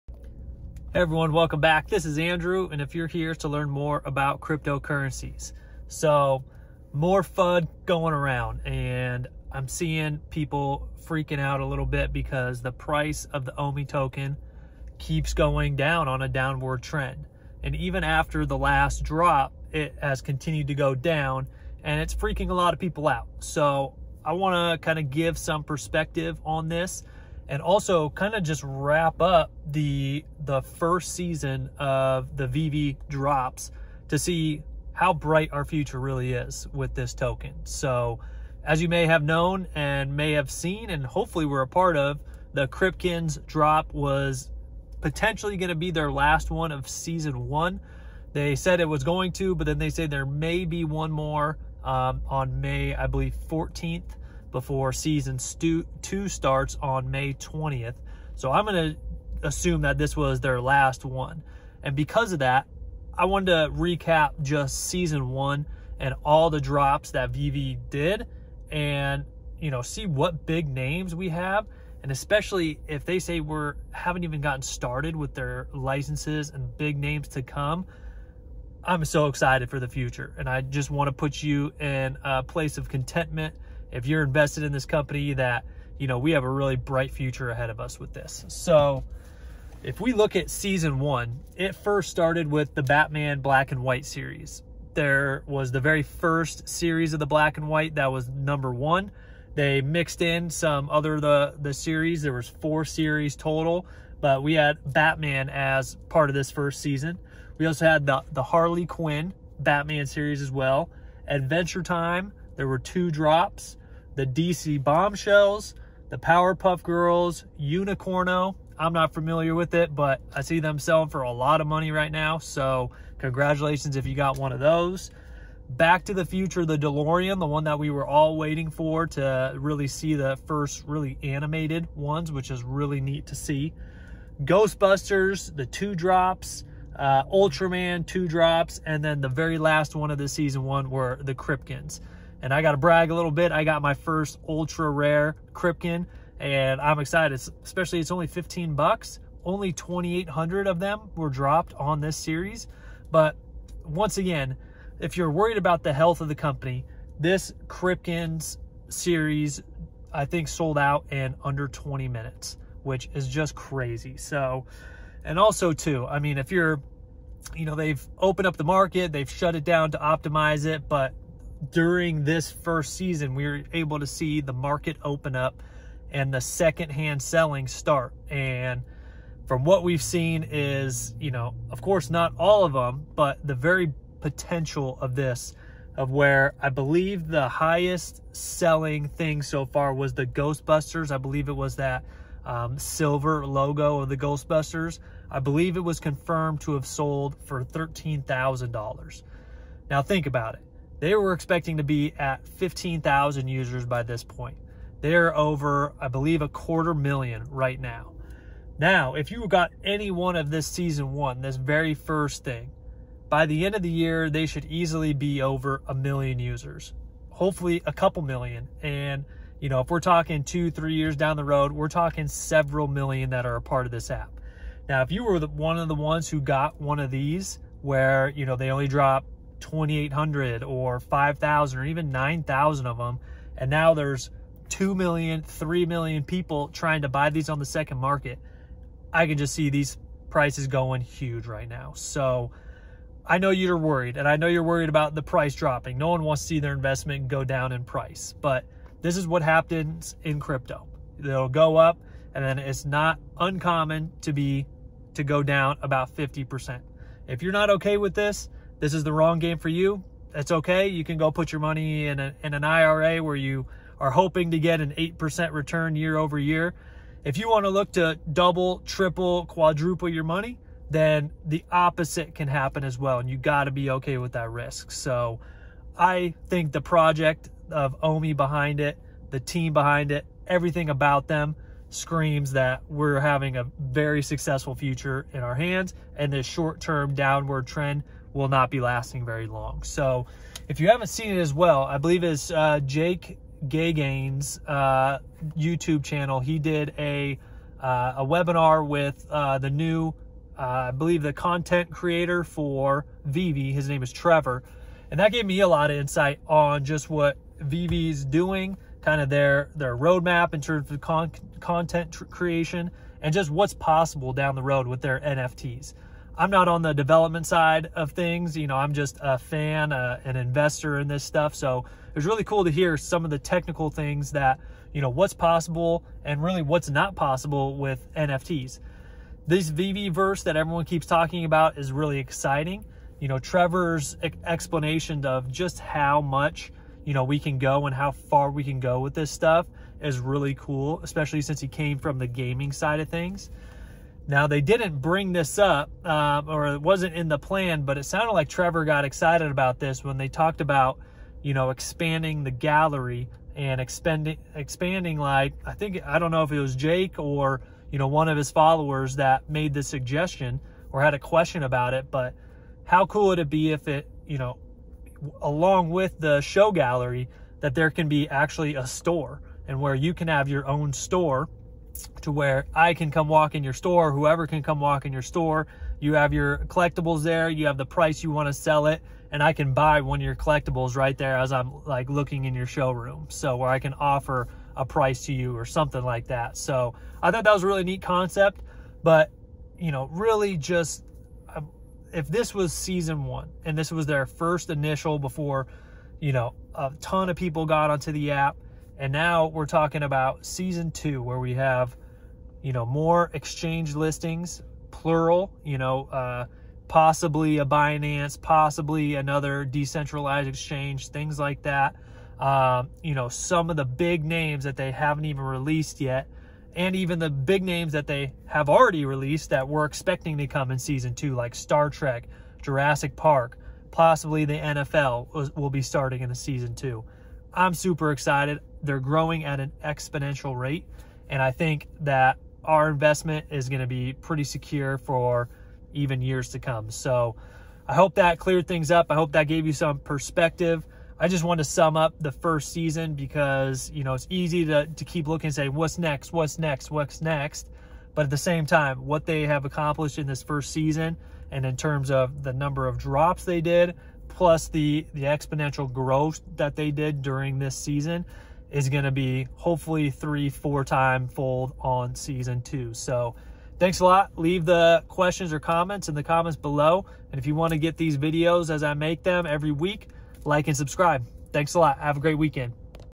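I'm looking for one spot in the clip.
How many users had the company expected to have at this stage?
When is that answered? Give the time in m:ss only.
3:22.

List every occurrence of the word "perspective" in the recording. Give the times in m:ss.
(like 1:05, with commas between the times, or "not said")
0:25, 7:19.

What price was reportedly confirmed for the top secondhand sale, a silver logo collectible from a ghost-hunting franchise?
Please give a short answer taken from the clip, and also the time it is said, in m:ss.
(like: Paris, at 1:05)
$13,000, at 3:17.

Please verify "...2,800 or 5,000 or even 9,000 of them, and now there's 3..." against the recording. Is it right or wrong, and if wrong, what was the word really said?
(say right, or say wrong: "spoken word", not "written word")
wrong: "2", not "3".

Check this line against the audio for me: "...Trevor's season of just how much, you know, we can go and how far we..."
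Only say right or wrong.
wrong.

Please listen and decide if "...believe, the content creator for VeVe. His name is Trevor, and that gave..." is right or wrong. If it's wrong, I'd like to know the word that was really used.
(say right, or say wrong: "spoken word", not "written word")
right.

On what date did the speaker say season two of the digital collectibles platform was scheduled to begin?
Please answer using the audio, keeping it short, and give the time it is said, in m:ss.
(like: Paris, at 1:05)
May 20th, at 0:57.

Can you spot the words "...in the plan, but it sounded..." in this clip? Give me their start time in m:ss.
5:47.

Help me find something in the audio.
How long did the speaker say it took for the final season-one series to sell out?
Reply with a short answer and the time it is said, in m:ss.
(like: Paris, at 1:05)
under 20 minutes, at 2:41.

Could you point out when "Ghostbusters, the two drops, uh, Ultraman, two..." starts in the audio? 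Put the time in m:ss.
2:14.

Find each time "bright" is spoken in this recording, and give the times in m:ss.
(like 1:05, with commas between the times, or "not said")
0:35, 1:26.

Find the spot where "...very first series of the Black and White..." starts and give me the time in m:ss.
1:35.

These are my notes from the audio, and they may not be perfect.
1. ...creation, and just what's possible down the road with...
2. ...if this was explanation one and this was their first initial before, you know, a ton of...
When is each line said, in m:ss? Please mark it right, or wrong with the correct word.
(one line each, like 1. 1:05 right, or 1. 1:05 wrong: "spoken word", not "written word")
1. 5:12 right
2. 6:32 wrong: "season", not "explanation".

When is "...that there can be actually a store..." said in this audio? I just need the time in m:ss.
6:07.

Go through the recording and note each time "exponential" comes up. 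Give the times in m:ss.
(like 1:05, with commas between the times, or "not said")
7:09, 7:35.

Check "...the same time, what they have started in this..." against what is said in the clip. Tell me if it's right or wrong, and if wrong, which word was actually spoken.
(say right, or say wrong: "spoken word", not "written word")
wrong: "accomplished", not "started".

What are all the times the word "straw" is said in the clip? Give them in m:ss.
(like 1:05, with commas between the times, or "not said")
not said.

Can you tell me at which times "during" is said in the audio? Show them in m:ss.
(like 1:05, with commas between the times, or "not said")
2:51, 7:37.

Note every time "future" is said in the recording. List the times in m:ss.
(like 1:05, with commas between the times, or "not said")
0:35, 1:19, 1:27, 2:06, 4:44.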